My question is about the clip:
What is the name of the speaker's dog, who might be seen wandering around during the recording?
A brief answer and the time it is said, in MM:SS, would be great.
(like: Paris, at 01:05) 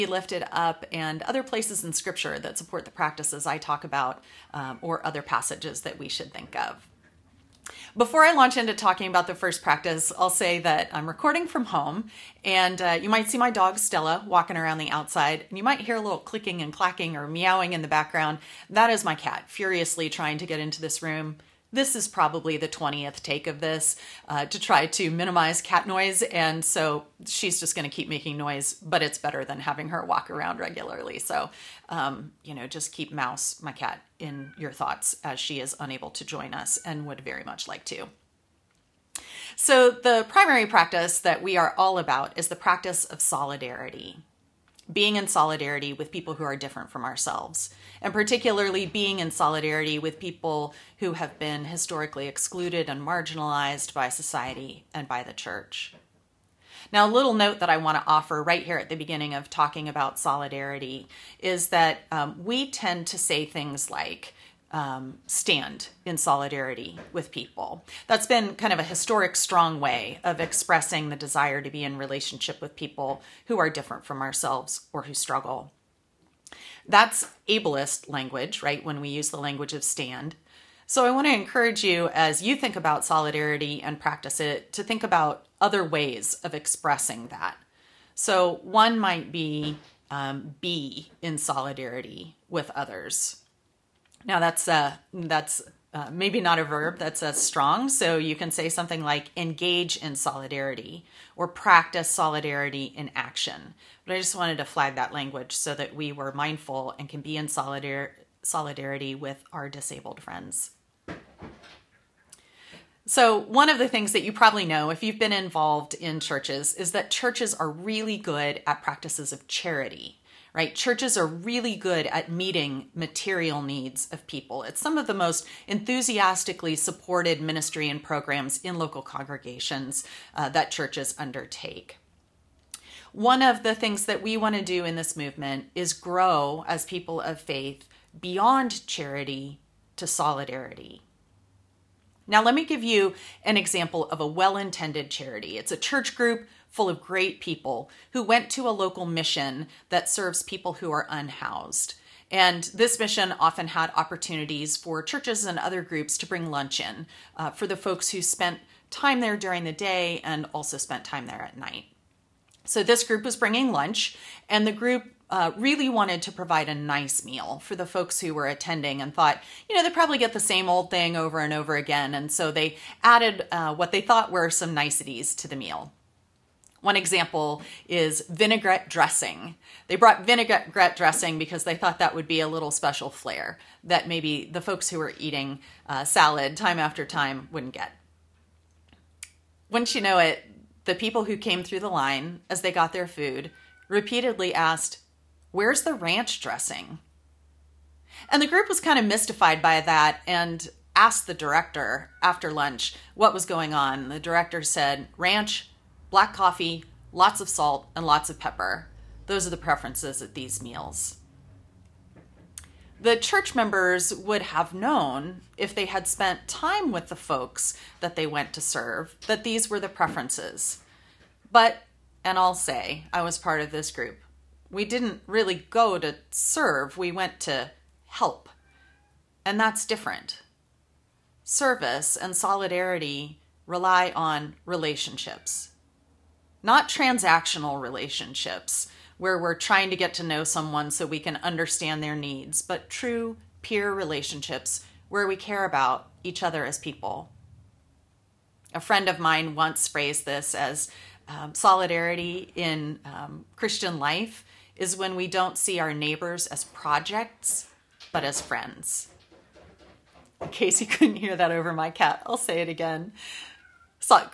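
Stella, at 00:13.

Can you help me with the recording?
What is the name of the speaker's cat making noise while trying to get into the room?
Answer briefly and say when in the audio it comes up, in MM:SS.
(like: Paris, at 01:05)
Mouse, at 00:33.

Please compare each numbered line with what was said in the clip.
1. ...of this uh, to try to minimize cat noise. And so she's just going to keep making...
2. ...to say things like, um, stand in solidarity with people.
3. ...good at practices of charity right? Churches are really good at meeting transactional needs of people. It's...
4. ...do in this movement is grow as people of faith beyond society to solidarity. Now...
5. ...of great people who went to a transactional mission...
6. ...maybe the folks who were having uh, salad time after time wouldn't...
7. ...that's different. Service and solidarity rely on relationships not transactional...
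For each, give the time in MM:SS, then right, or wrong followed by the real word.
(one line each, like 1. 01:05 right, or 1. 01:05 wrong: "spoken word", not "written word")
1. 00:23 right
2. 01:03 right
3. 01:58 wrong: "material", not "transactional"
4. 02:14 wrong: "charity", not "society"
5. 02:26 wrong: "local", not "transactional"
6. 03:04 wrong: "eating", not "having"
7. 03:49 right.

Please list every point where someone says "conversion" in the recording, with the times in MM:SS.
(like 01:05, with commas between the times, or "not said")
not said.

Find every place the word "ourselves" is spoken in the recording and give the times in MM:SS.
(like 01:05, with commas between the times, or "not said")
00:47, 01:14.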